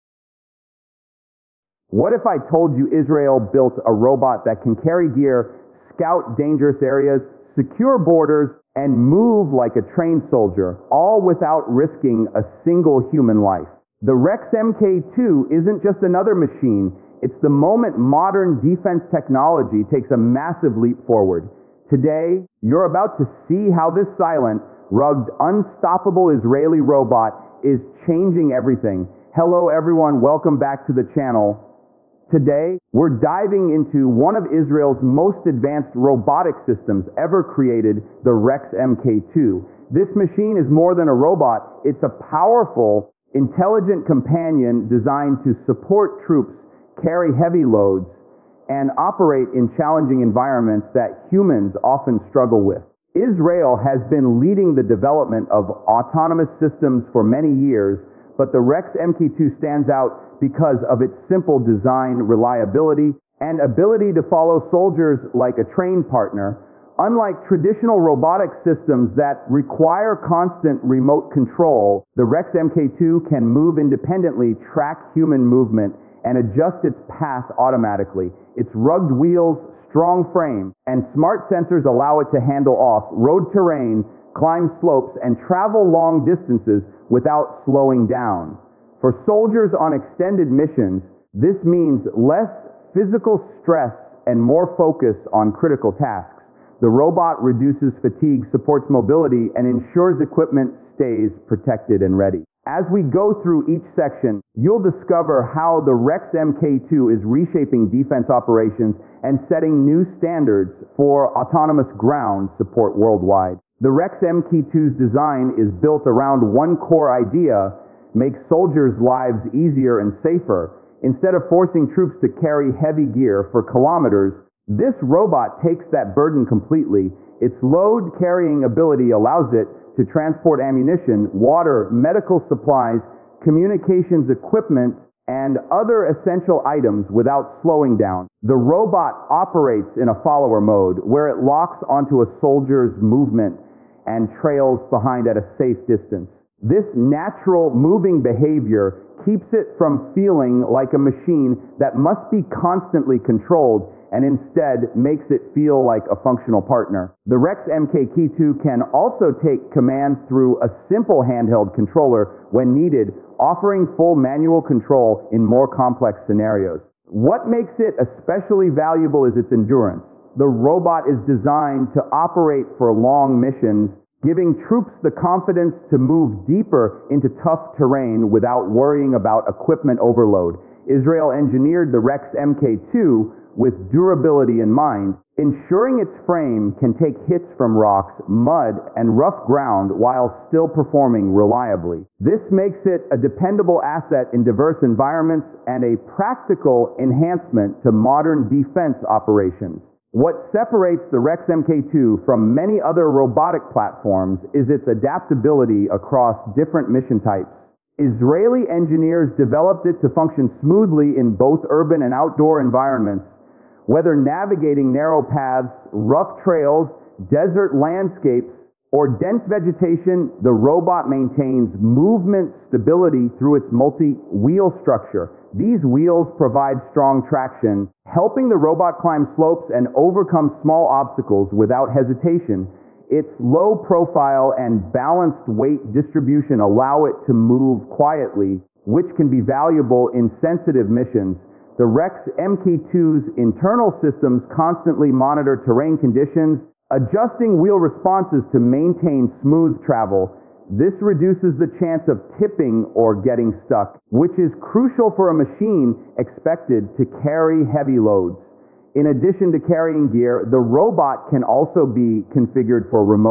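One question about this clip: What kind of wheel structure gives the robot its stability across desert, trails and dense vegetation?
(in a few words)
Multi-wheel structure.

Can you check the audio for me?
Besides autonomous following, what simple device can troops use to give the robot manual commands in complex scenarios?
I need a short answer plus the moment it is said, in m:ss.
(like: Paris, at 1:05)
Handheld controller, at 2:41.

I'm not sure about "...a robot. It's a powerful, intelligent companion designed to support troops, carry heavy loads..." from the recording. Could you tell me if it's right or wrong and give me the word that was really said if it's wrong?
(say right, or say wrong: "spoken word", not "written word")
right.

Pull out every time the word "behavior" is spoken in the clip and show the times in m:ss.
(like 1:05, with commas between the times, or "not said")
2:28.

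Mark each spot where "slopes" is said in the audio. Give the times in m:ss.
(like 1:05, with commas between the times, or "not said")
1:24, 3:49.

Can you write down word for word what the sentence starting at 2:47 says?
What makes it especially valuable is its endurance.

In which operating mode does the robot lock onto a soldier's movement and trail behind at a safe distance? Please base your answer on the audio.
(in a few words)
Follower mode.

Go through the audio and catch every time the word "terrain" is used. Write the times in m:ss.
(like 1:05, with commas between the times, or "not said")
1:23, 2:57, 4:05.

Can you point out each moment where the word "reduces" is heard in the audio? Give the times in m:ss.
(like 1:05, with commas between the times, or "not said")
1:37, 4:10.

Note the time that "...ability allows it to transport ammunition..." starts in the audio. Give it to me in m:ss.
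2:08.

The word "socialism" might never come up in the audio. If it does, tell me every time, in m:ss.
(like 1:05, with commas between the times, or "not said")
not said.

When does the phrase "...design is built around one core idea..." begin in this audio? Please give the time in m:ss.
1:54.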